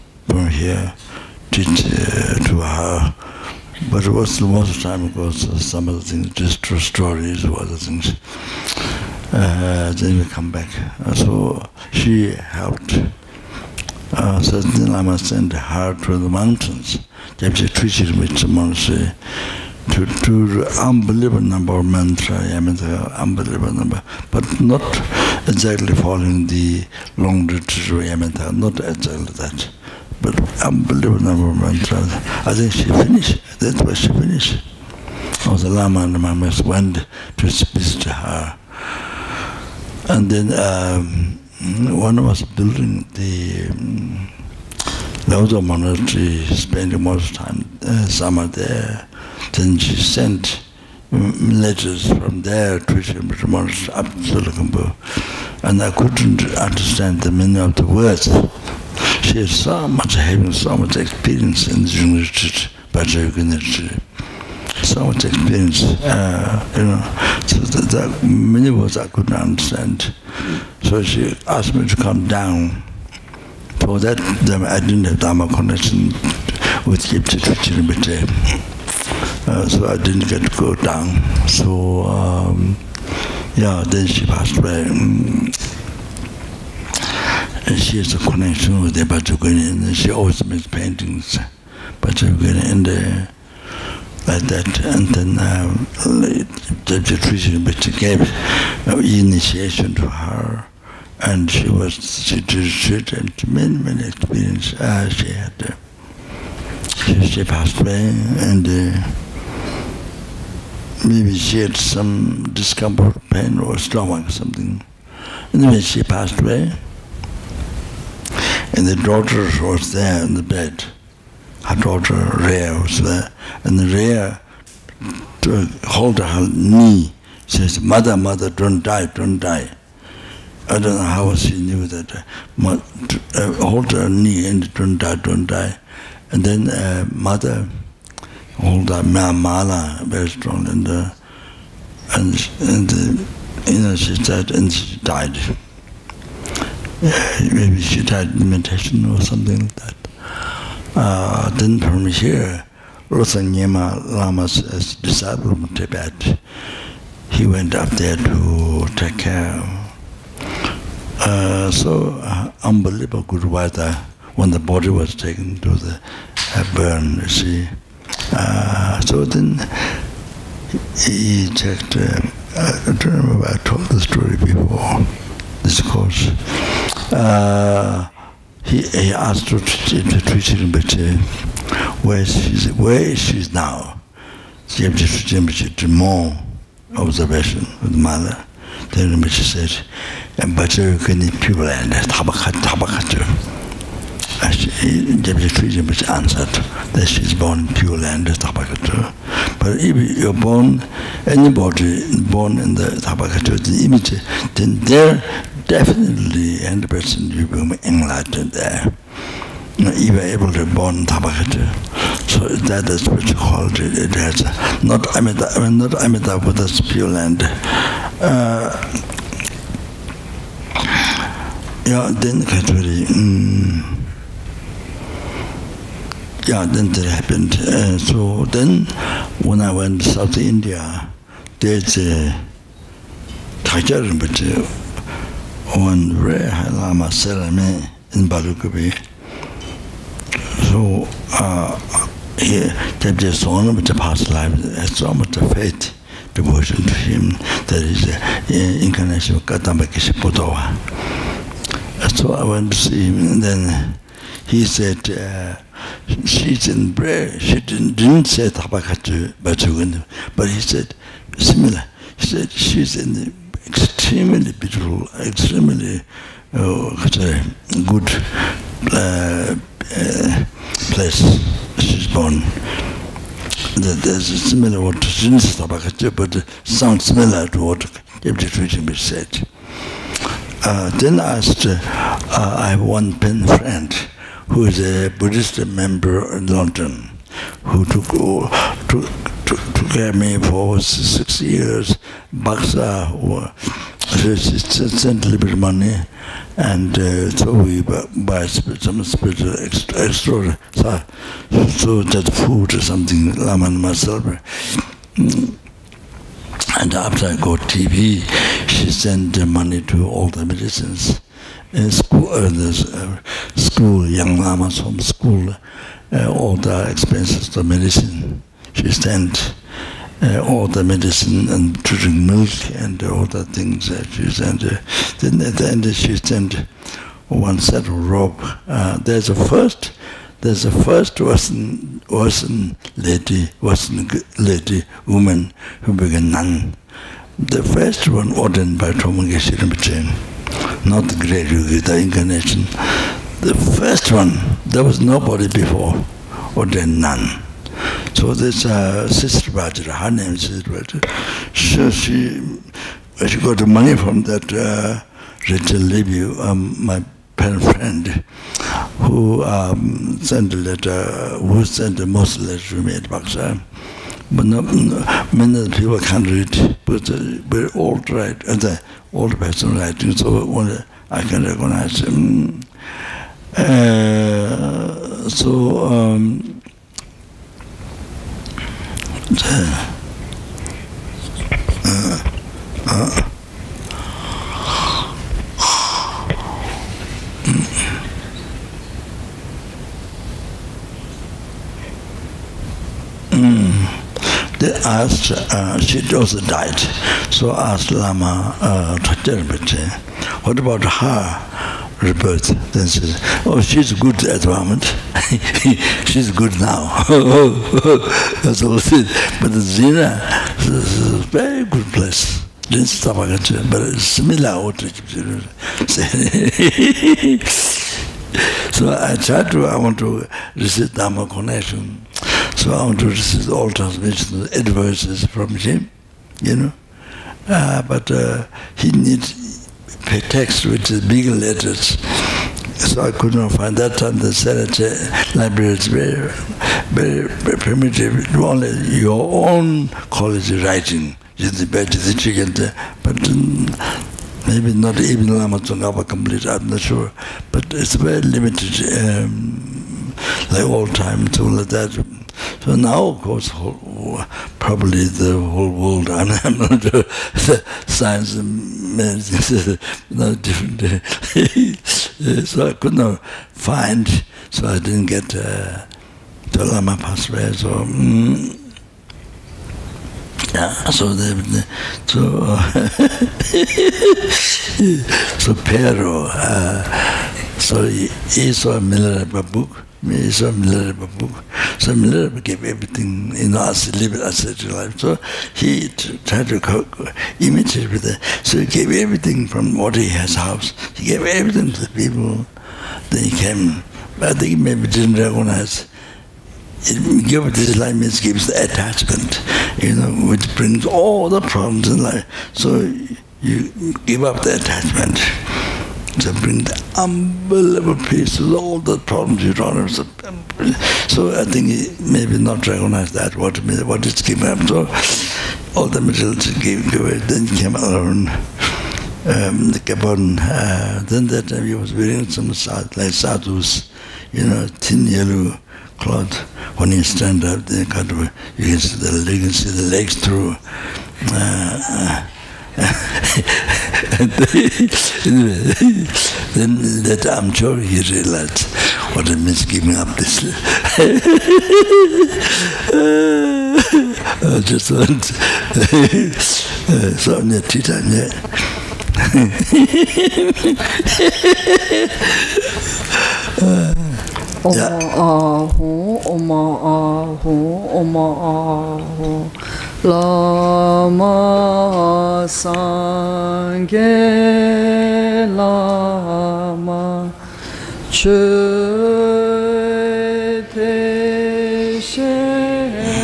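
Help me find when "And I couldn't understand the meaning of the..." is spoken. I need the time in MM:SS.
00:55.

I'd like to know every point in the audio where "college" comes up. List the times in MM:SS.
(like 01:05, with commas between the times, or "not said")
07:20.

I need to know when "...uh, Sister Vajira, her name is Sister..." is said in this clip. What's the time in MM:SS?
05:48.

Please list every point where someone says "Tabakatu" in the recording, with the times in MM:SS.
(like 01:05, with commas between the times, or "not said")
03:18, 03:22, 03:31.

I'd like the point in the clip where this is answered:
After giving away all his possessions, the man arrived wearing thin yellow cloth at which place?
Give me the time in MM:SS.
08:39.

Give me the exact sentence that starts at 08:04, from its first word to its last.
So he tried to imitate it with that.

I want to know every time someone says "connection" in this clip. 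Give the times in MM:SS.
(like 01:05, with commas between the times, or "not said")
01:15, 01:28, 07:01.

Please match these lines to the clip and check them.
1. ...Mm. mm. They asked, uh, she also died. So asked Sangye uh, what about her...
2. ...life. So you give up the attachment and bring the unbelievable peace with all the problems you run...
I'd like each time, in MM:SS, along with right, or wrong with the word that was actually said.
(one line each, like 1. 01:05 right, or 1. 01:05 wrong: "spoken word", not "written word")
1. 06:33 wrong: "Lama", not "Sangye"
2. 08:22 right.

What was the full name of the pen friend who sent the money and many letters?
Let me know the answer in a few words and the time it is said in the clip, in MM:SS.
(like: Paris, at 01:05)
Rachel Levy, at 05:55.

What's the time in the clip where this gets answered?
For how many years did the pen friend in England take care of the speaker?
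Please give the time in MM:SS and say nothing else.
04:50.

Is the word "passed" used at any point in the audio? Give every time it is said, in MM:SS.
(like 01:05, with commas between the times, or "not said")
01:24, 01:47, 01:56, 07:46.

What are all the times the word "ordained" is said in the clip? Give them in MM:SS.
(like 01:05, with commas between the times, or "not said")
05:38.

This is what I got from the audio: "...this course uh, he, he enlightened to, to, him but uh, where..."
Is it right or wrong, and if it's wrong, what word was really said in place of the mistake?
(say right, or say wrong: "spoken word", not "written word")
wrong: "asked", not "enlightened".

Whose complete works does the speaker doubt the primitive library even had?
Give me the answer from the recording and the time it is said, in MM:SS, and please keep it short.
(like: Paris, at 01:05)
Lama Tsongkhapa, at 07:25.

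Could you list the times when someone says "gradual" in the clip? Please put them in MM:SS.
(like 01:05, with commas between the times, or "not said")
05:41.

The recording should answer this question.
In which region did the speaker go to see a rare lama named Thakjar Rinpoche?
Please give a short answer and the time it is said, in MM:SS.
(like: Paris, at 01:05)
South India, at 03:50.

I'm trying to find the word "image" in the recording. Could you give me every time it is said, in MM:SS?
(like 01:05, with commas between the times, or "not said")
03:23.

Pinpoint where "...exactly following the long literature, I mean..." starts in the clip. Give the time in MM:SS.
00:25.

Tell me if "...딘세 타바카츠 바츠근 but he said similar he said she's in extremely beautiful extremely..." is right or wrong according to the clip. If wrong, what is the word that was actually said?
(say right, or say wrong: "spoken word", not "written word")
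right.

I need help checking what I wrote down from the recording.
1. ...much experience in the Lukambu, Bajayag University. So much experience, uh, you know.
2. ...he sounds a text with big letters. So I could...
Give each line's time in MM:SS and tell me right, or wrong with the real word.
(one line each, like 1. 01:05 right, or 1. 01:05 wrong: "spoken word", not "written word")
1. 01:00 wrong: "University", not "Lukambu"
2. 07:08 wrong: "needs", not "sounds".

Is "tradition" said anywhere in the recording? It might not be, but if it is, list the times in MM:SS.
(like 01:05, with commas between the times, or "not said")
01:37, 04:38.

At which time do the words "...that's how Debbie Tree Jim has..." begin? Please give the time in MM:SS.
03:11.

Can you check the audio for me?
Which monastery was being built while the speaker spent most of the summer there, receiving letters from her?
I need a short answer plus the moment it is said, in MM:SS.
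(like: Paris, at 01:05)
Lawudo monastery, at 00:45.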